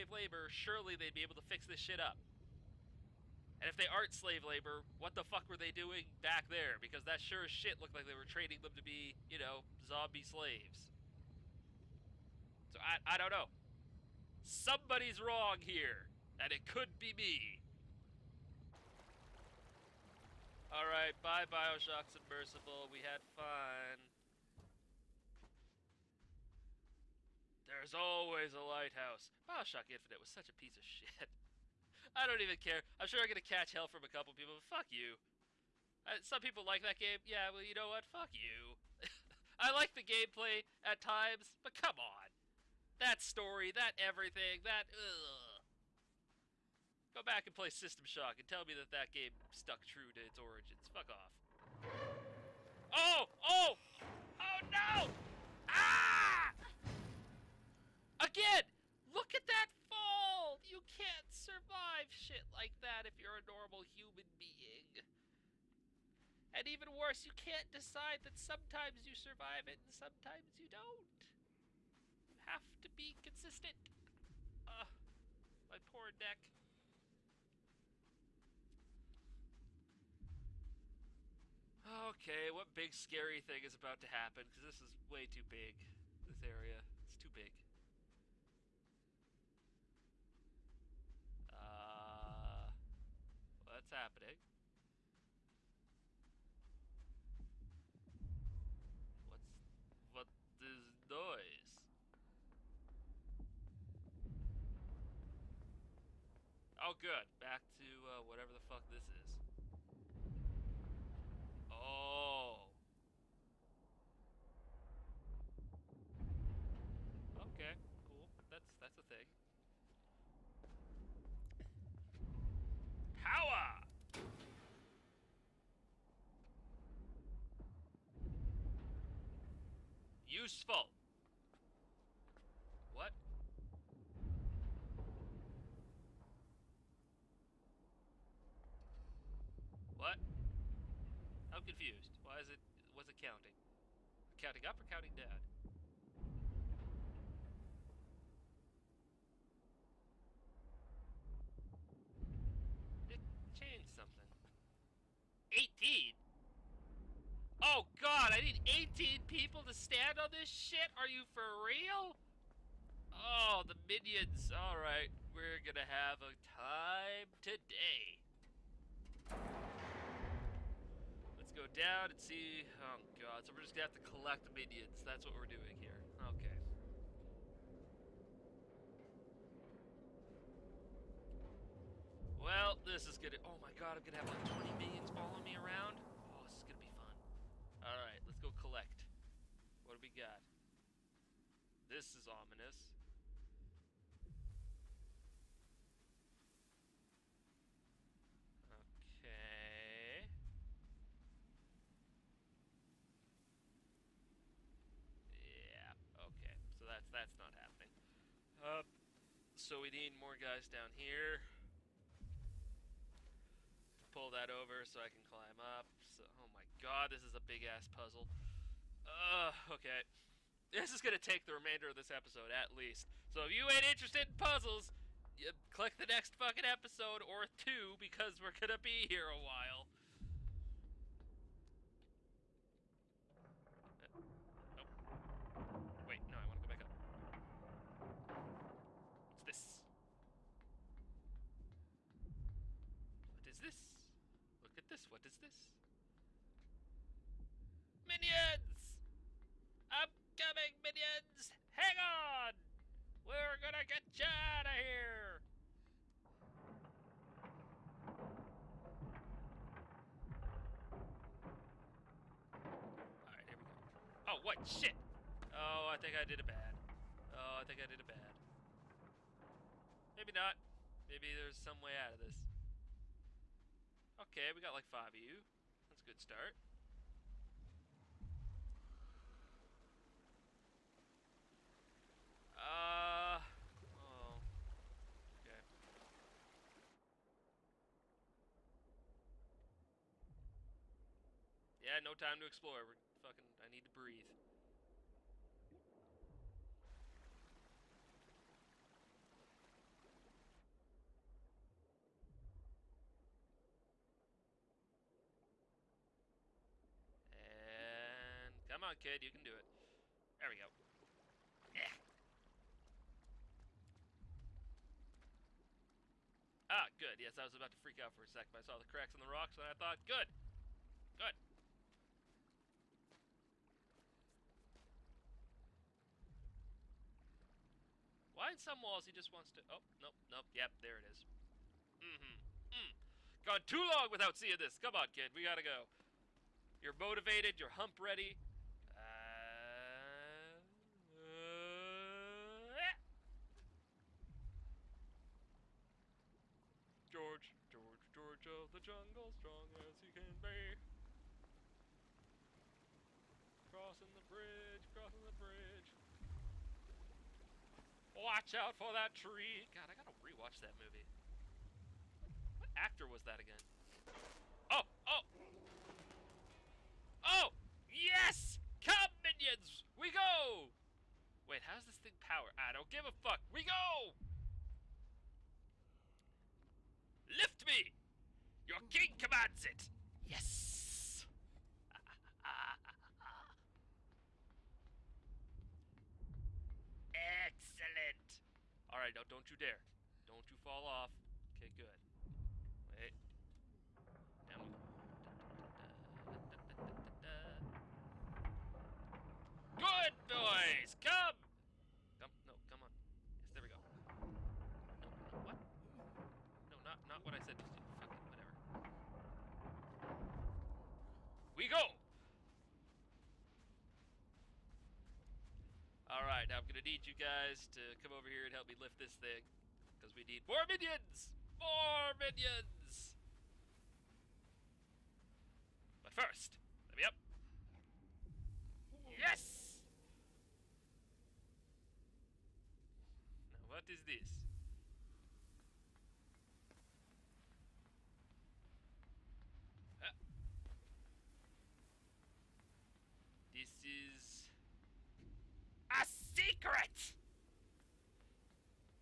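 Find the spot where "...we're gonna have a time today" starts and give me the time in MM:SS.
02:45.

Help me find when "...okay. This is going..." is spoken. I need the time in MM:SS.
03:39.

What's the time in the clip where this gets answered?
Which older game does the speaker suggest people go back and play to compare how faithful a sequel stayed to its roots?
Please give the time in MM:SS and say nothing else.
00:47.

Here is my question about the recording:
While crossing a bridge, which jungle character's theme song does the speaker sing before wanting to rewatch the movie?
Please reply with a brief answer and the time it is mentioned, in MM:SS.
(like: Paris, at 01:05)
George of the Jungle, at 05:48.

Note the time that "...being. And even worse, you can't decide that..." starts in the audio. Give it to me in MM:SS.
01:04.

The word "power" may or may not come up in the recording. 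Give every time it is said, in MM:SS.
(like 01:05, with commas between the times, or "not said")
02:03, 06:12.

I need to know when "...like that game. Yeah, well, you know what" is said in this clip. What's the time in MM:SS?
00:36.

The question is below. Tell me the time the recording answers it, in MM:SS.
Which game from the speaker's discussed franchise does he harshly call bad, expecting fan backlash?
00:29.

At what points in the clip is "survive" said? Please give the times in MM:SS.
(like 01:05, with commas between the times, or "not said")
01:01, 01:09.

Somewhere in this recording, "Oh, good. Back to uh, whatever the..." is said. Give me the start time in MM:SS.
01:46.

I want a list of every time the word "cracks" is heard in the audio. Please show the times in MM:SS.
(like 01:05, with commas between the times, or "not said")
05:18.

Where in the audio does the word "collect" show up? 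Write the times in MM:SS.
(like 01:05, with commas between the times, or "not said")
02:54, 03:08.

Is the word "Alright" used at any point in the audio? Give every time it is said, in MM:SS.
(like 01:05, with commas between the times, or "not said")
00:20, 02:44, 04:16, 06:28, 06:56.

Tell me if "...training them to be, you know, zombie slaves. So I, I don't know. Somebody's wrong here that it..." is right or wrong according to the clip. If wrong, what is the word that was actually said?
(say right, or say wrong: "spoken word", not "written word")
right.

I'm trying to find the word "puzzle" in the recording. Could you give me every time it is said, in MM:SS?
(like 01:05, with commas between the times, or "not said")
03:37, 03:44.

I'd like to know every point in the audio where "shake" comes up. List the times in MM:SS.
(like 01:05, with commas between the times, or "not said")
not said.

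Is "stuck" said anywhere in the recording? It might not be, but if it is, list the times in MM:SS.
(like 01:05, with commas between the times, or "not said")
00:49.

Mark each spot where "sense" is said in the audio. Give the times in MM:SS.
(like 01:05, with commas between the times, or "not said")
not said.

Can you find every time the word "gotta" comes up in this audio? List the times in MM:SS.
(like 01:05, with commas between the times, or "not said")
05:35, 05:59.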